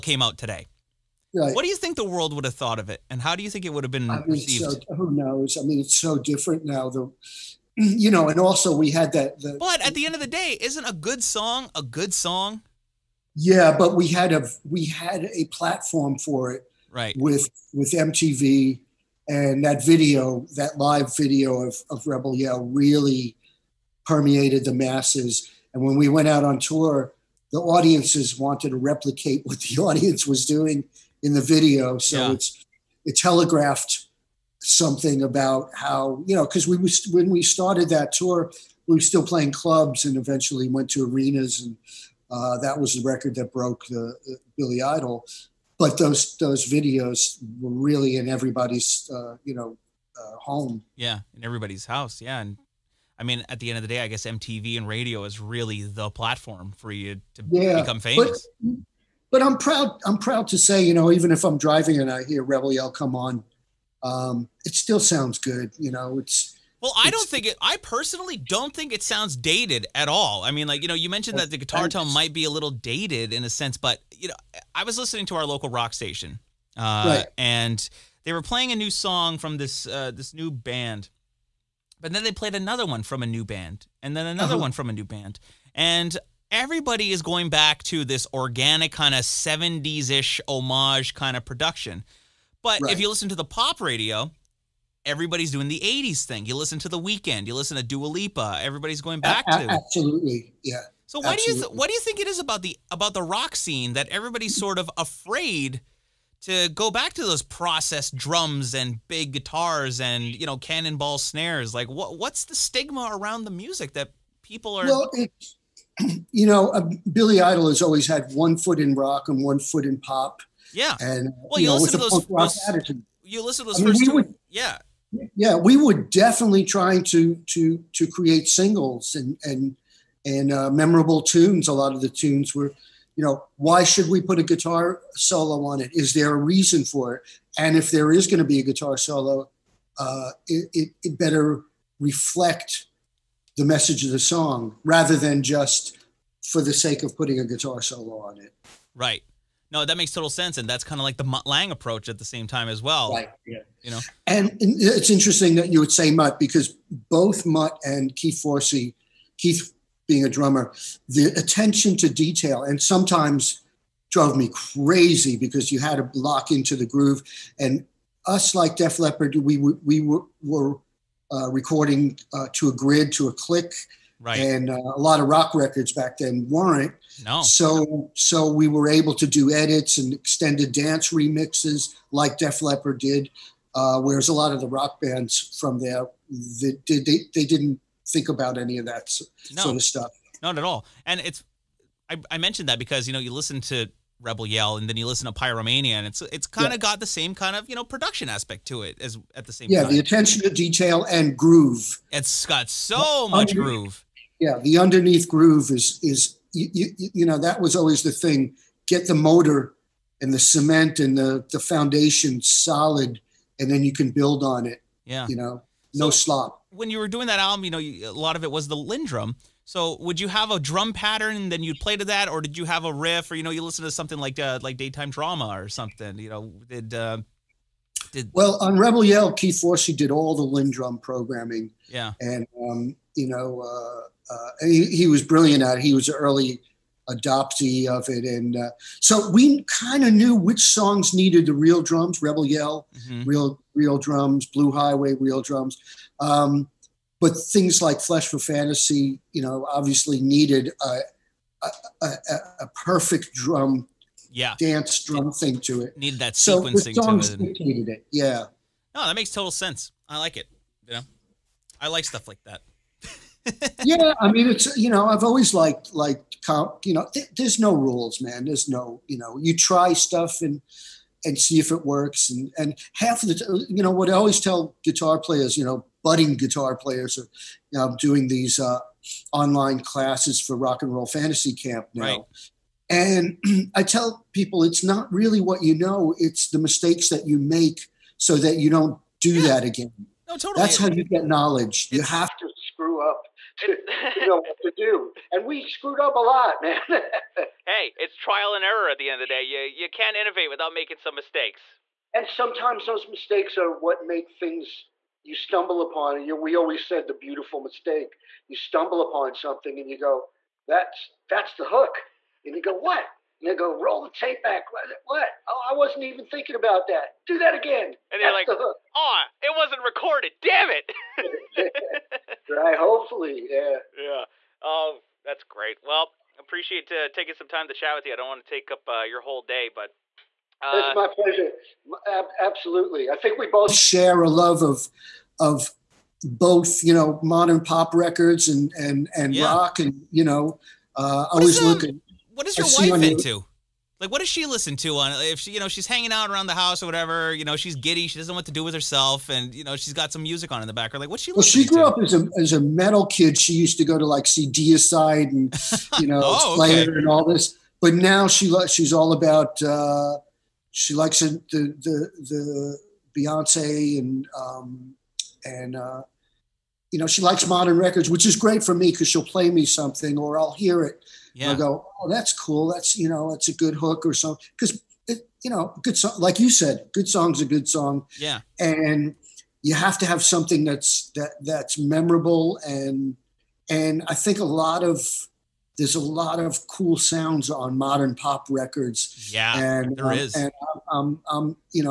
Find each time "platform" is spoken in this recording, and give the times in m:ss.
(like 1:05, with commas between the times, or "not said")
0:15, 0:56.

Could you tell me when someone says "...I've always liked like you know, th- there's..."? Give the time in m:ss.
4:25.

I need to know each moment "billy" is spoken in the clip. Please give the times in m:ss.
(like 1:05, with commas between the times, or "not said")
0:44, 1:57.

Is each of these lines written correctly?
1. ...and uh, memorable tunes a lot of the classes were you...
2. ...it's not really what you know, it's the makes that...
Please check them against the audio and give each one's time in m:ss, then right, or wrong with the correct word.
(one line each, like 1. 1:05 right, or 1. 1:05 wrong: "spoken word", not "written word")
1. 2:10 wrong: "tunes", not "classes"
2. 4:44 wrong: "mistakes", not "makes".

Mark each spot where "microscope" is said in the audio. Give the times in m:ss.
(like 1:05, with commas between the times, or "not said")
not said.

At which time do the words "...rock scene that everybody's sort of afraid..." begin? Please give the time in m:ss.
1:43.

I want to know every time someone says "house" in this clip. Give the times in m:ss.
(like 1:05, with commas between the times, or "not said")
0:51, 5:46.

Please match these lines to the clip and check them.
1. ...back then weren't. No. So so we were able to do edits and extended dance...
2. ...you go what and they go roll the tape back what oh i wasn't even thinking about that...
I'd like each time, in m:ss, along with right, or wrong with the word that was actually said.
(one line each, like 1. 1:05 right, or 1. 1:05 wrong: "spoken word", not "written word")
1. 2:55 right
2. 5:12 right.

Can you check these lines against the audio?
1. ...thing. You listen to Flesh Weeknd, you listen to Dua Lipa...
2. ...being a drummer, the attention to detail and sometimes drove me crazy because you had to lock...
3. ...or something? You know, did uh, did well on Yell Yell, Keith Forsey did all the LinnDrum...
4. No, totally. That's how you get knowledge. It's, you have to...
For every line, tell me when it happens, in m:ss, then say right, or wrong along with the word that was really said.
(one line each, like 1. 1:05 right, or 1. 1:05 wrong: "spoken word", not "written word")
1. 1:36 wrong: "The", not "Flesh"
2. 2:40 right
3. 3:45 wrong: "Rebel", not "Yell"
4. 4:50 right.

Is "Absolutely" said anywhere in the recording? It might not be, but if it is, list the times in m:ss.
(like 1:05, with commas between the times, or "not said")
1:39, 5:32.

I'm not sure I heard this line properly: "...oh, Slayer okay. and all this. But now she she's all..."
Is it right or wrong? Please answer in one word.
right.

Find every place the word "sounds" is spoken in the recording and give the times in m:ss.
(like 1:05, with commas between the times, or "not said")
1:04, 1:09, 6:26.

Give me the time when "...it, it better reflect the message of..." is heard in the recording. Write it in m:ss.
2:20.